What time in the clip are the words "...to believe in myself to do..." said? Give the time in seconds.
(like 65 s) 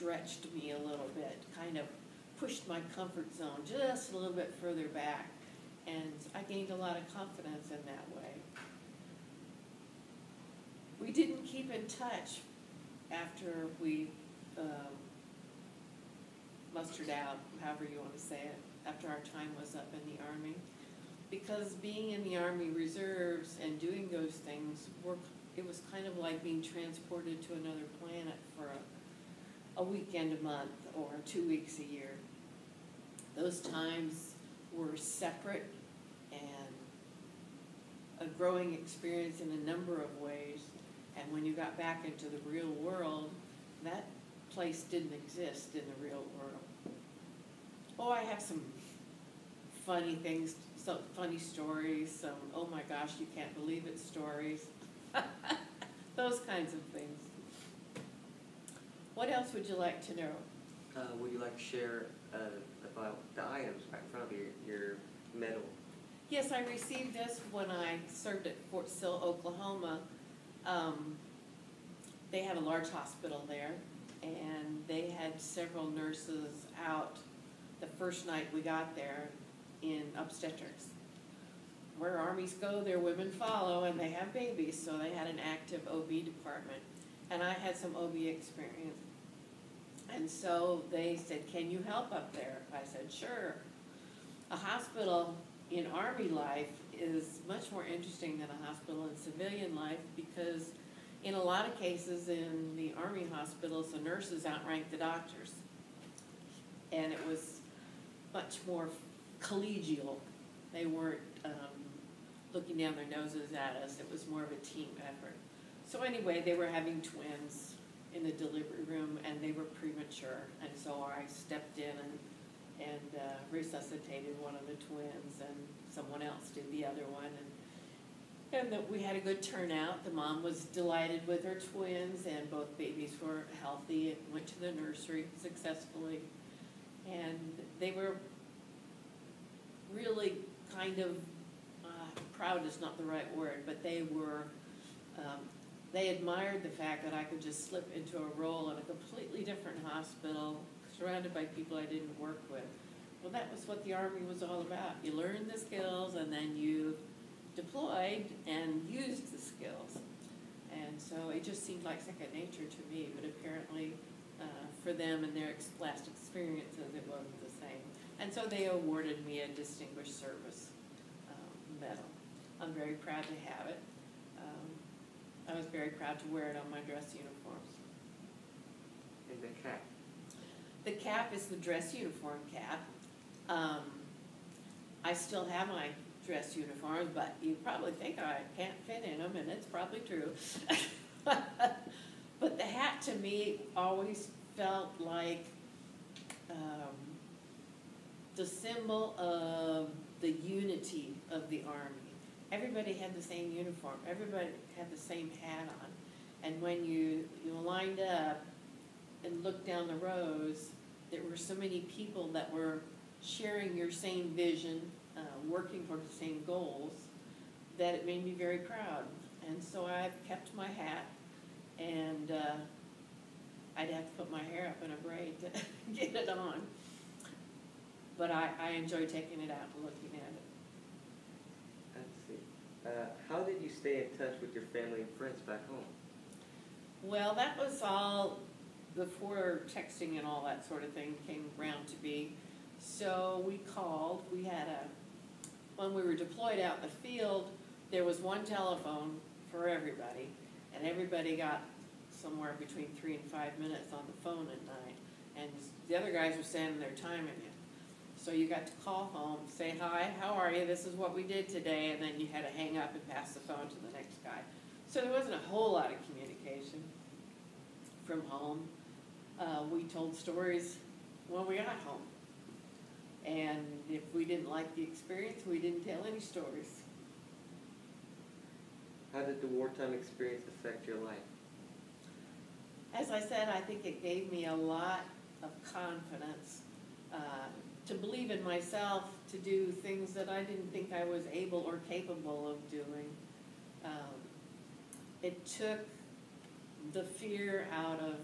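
287 s.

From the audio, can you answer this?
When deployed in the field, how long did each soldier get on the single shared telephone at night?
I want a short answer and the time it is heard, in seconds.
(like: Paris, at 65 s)
3 to 5 minutes, at 252 s.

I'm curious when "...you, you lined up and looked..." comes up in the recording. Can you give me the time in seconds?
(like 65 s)
206 s.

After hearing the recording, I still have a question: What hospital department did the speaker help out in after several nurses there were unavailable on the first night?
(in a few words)
Obstetrics.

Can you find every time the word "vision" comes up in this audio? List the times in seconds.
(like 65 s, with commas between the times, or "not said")
214 s.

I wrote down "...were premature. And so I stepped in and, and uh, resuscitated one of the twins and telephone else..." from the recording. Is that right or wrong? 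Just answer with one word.
wrong.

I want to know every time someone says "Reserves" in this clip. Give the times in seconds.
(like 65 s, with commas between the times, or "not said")
22 s.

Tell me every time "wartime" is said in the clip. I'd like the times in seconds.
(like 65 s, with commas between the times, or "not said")
279 s.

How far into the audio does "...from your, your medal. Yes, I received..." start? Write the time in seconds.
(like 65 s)
64 s.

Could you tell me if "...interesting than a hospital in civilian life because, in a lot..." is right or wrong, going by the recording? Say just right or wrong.
right.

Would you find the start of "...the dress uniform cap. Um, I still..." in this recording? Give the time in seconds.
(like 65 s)
181 s.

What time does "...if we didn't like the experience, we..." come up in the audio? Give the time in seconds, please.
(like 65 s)
273 s.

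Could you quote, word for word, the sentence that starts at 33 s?
Those times were separate and a growing experience in a number of ways.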